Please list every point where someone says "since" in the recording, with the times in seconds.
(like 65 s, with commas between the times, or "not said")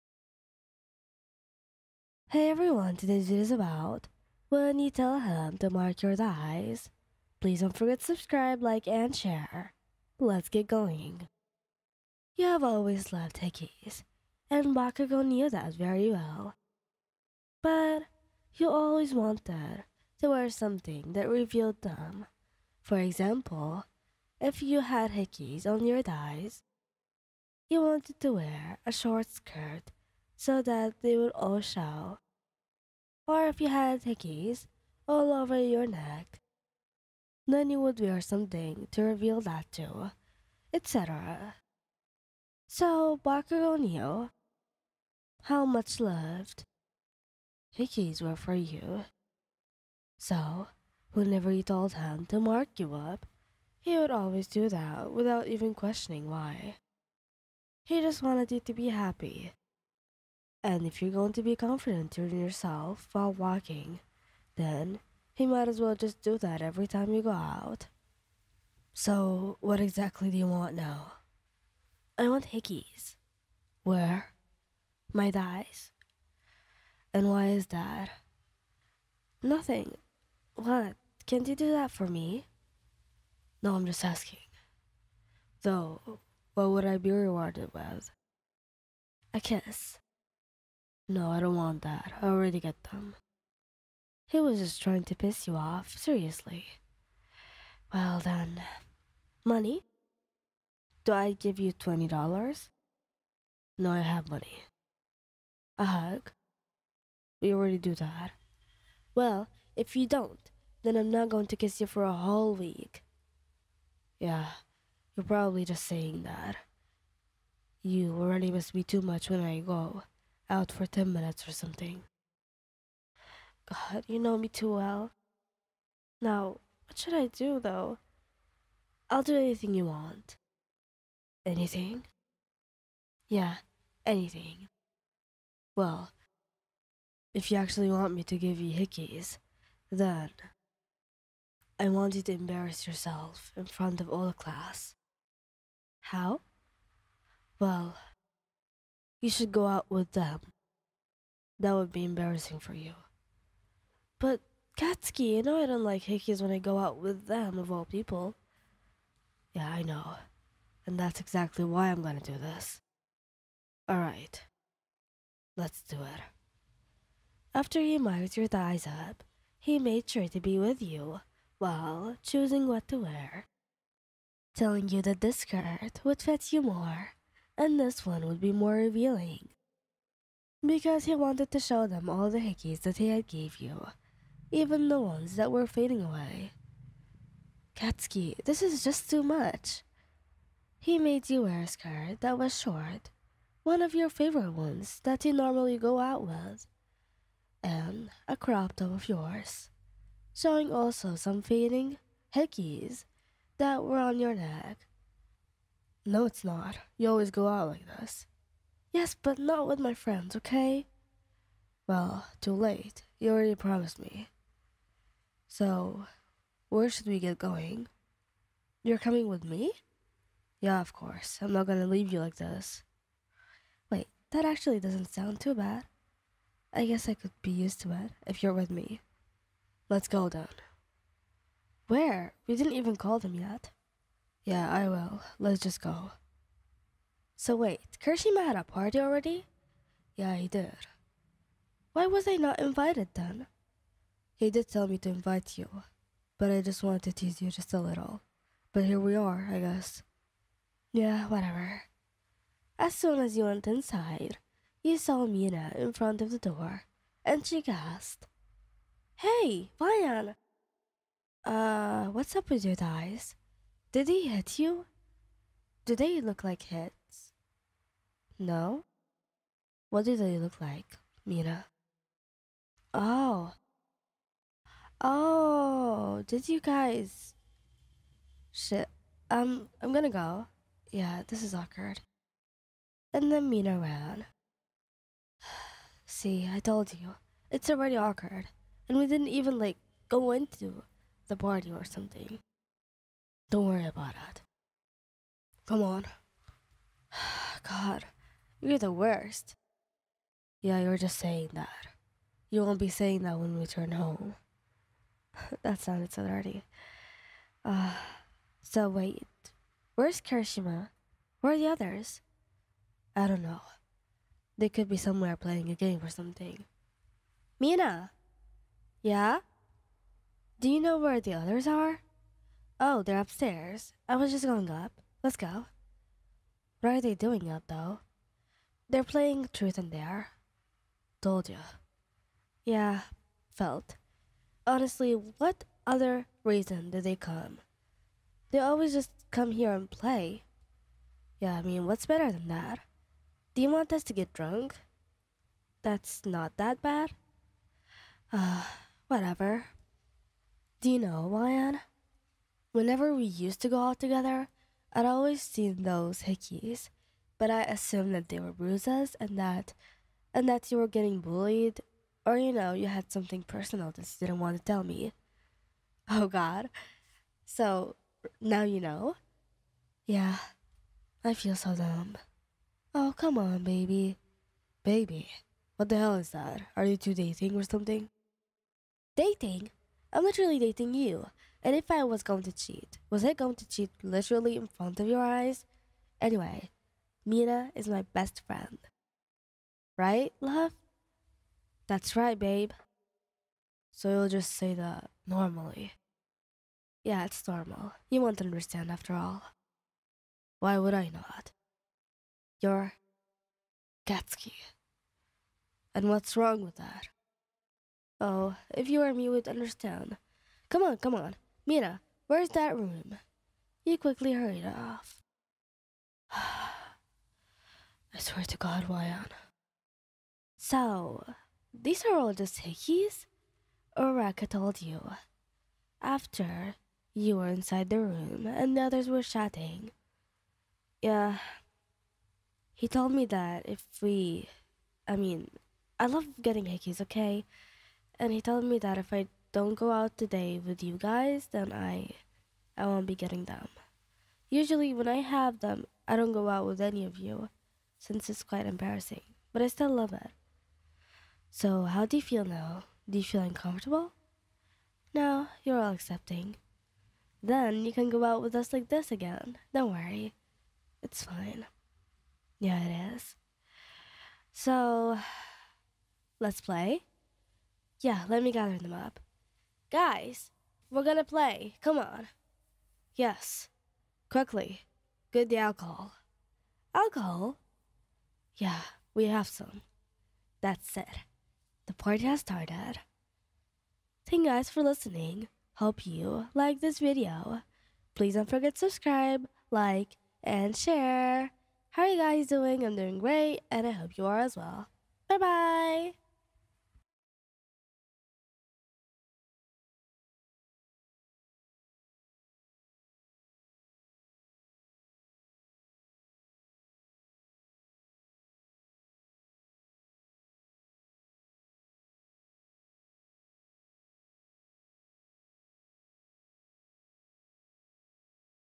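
447 s.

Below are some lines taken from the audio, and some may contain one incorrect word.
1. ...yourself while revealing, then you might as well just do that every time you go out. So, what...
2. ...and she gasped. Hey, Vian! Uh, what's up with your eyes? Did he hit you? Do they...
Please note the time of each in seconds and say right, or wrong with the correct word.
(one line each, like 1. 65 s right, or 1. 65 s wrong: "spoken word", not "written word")
1. 62 s wrong: "walking", not "revealing"
2. 257 s right.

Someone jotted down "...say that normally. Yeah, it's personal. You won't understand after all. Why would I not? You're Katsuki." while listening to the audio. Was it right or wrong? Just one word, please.
wrong.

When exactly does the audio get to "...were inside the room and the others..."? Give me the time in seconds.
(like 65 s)
427 s.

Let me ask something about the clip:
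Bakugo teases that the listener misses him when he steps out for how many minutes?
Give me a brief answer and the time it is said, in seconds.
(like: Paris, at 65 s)
10, at 120 s.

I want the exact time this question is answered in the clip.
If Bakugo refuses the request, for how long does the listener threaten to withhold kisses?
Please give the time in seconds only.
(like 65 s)
112 s.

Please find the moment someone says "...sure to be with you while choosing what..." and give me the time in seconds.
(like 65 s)
170 s.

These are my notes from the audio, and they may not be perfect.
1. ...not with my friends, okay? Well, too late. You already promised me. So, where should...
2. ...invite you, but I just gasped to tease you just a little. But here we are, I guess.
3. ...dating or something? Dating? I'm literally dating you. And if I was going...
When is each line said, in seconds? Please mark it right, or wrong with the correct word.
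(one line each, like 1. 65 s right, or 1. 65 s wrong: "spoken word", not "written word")
1. 209 s right
2. 245 s wrong: "wanted", not "gasped"
3. 377 s right.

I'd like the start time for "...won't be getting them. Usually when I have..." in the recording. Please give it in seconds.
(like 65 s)
442 s.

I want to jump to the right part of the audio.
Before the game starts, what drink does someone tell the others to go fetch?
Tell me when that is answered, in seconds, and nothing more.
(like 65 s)
475 s.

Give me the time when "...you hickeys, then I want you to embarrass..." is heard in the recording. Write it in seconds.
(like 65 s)
138 s.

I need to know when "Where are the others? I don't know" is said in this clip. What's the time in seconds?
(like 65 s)
311 s.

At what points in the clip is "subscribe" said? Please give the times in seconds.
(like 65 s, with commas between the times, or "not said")
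8 s, 488 s.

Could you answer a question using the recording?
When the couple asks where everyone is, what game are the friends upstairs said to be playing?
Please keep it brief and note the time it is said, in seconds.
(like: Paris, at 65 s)
Truth and dare, at 329 s.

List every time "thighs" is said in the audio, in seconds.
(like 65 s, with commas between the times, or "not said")
26 s, 75 s, 168 s.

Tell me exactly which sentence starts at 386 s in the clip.
Anyway, Mina is my best friend.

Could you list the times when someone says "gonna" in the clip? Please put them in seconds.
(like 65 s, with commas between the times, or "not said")
162 s, 221 s, 279 s, 471 s.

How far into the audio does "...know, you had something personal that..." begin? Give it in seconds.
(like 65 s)
362 s.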